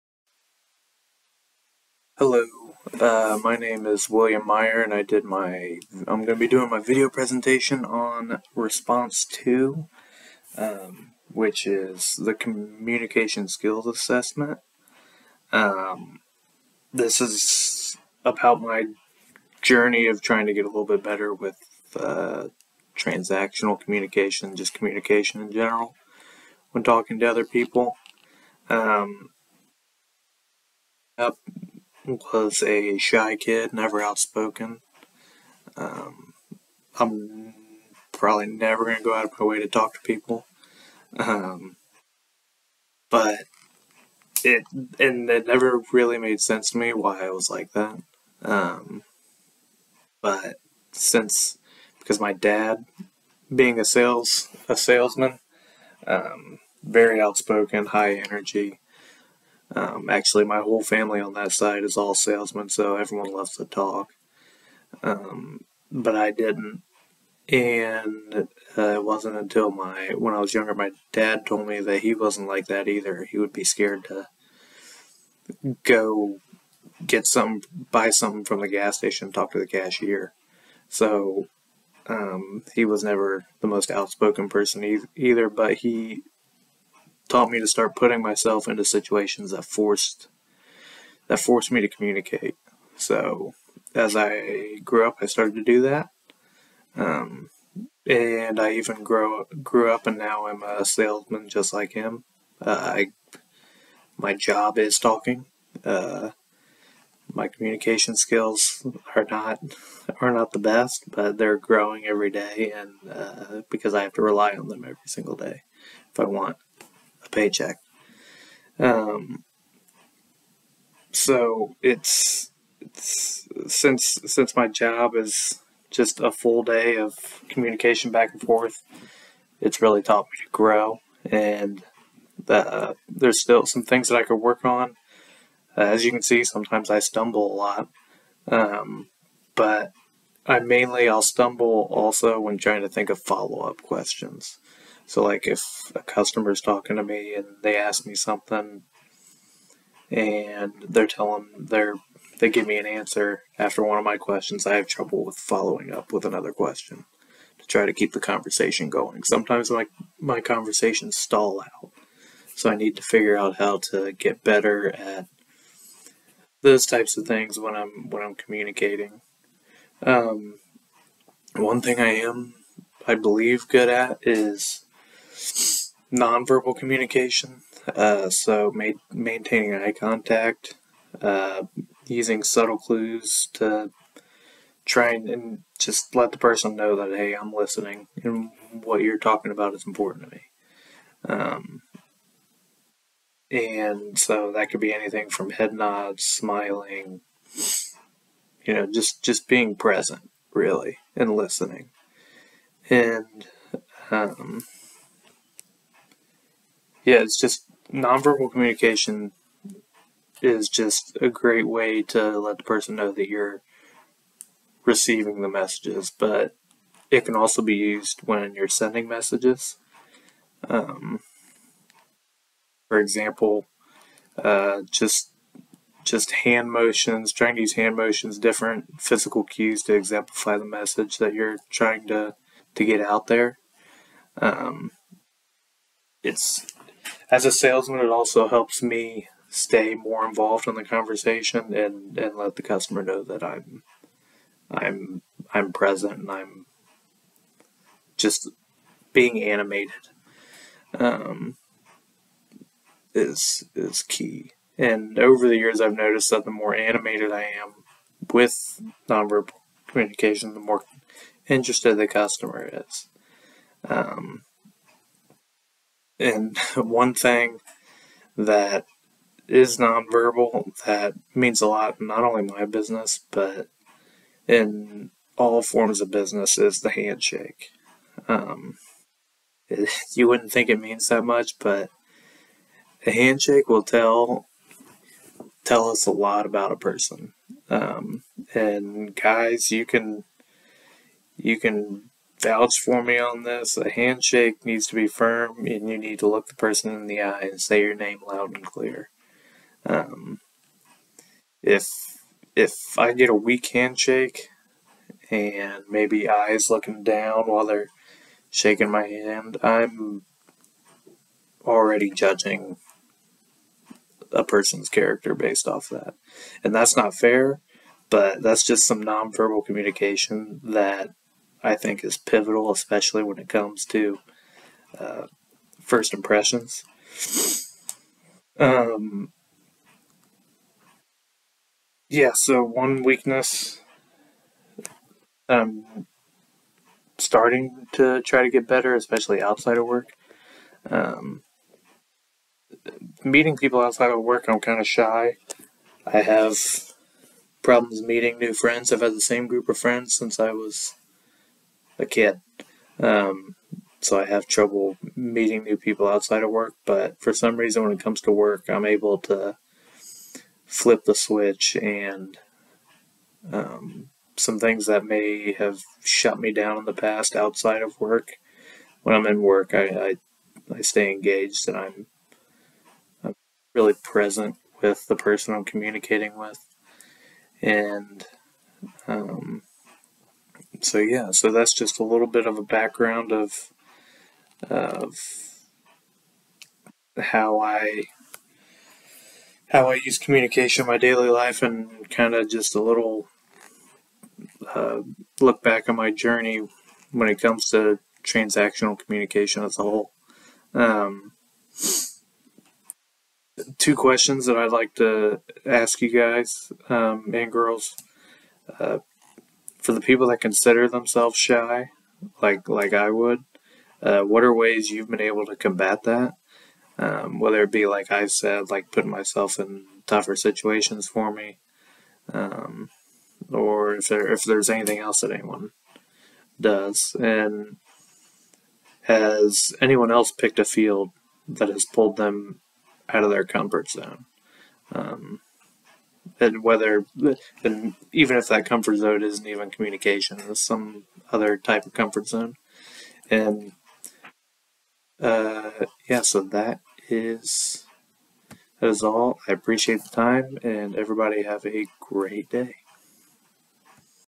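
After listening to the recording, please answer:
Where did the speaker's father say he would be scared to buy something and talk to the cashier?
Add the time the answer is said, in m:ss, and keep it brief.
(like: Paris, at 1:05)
The gas station, at 1:18.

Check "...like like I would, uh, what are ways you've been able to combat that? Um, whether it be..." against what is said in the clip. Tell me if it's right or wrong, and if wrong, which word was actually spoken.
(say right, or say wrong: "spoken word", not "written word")
right.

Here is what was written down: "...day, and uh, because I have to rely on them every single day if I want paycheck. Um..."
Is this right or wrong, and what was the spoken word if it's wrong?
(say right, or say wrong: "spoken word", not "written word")
right.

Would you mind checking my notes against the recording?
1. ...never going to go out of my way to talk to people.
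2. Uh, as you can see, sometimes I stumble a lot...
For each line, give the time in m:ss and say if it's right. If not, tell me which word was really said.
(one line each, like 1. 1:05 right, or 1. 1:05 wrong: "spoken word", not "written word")
1. 0:38 right
2. 2:15 right.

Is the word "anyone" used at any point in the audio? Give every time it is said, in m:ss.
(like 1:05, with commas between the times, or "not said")
7:05, 7:09.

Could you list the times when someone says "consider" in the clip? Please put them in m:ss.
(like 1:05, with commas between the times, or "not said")
6:50.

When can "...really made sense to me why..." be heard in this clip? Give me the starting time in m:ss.
0:45.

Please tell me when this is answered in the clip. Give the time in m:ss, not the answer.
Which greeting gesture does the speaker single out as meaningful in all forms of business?
4:36.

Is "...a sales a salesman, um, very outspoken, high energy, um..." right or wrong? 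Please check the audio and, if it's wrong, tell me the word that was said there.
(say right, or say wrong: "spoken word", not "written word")
right.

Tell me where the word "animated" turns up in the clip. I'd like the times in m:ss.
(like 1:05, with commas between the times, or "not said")
4:09, 4:16.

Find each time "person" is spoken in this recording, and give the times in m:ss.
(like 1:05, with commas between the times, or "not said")
1:24, 3:06, 3:32, 4:46, 4:56, 5:14, 6:15.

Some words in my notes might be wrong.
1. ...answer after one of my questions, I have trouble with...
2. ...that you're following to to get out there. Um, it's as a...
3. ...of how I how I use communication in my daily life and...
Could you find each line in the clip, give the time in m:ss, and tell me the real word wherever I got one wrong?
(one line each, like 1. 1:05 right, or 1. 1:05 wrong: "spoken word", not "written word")
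1. 2:32 right
2. 3:51 wrong: "trying", not "following"
3. 6:24 right.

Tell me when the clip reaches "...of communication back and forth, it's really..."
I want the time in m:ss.
2:06.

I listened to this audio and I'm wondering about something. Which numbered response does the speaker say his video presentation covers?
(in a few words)
Response 2.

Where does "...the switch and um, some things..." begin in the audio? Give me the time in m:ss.
6:01.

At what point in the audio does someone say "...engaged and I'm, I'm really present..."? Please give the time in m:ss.
6:11.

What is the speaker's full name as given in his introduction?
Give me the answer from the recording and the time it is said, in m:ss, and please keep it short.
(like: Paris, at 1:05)
William Meyer, at 0:04.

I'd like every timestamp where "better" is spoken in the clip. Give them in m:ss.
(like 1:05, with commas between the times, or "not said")
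0:21, 2:44, 5:38.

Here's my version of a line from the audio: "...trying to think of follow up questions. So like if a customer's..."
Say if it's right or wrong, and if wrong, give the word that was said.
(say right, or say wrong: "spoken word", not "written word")
right.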